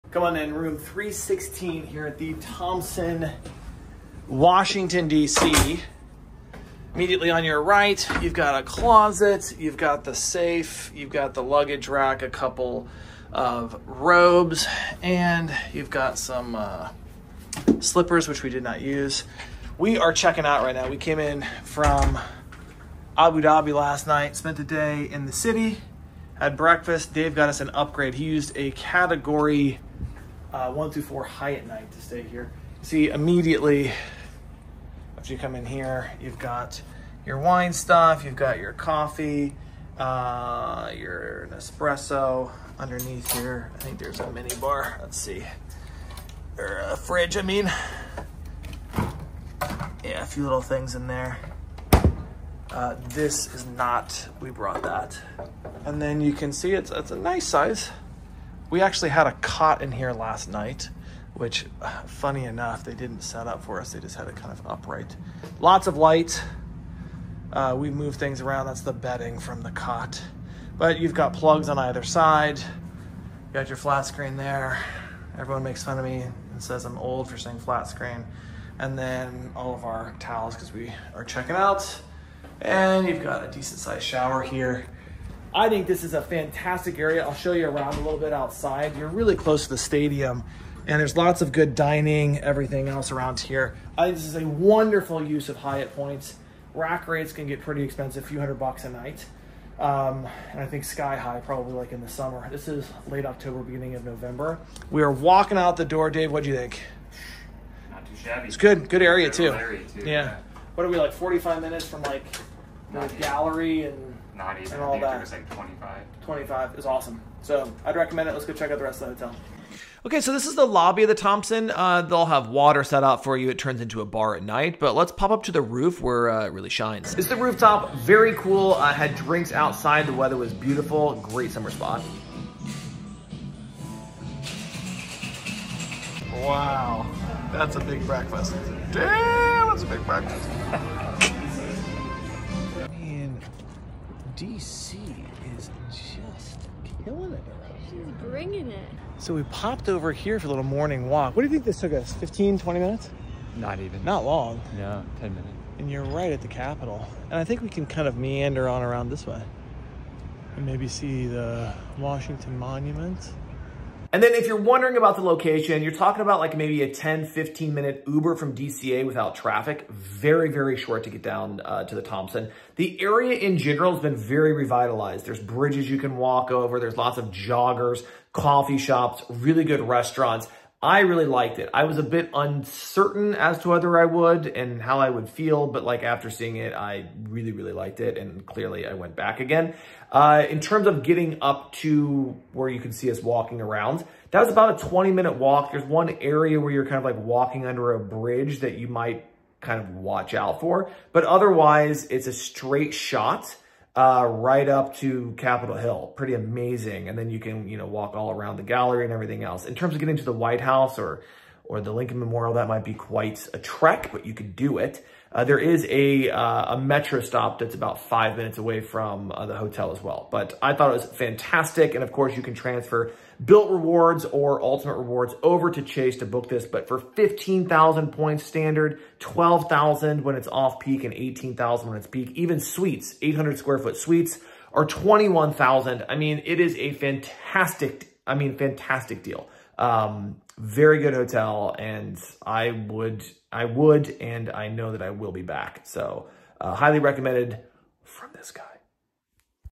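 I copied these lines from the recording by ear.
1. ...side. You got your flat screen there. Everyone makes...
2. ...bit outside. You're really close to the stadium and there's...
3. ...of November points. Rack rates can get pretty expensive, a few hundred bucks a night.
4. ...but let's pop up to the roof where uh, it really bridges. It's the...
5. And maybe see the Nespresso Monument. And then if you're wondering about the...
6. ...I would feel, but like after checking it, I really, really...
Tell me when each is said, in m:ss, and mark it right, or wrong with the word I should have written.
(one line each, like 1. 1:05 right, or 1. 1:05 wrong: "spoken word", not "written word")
1. 1:12 right
2. 1:28 right
3. 1:35 wrong: "Hyatt", not "November"
4. 2:04 wrong: "shines", not "bridges"
5. 2:40 wrong: "Washington", not "Nespresso"
6. 3:04 wrong: "seeing", not "checking".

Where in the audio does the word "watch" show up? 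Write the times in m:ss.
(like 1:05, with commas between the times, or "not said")
3:19.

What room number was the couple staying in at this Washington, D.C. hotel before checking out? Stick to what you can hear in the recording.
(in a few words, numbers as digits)
316.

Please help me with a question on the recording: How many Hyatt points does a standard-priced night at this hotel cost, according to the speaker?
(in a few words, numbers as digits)
15,000.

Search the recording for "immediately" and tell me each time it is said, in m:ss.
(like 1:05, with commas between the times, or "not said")
0:06, 0:33.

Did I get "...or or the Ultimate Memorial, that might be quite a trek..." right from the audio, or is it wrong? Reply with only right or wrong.
wrong.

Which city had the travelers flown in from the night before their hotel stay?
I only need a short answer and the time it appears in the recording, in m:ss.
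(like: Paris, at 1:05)
Abu Dhabi, at 0:23.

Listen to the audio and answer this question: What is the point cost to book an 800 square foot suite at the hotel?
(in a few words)
21,000.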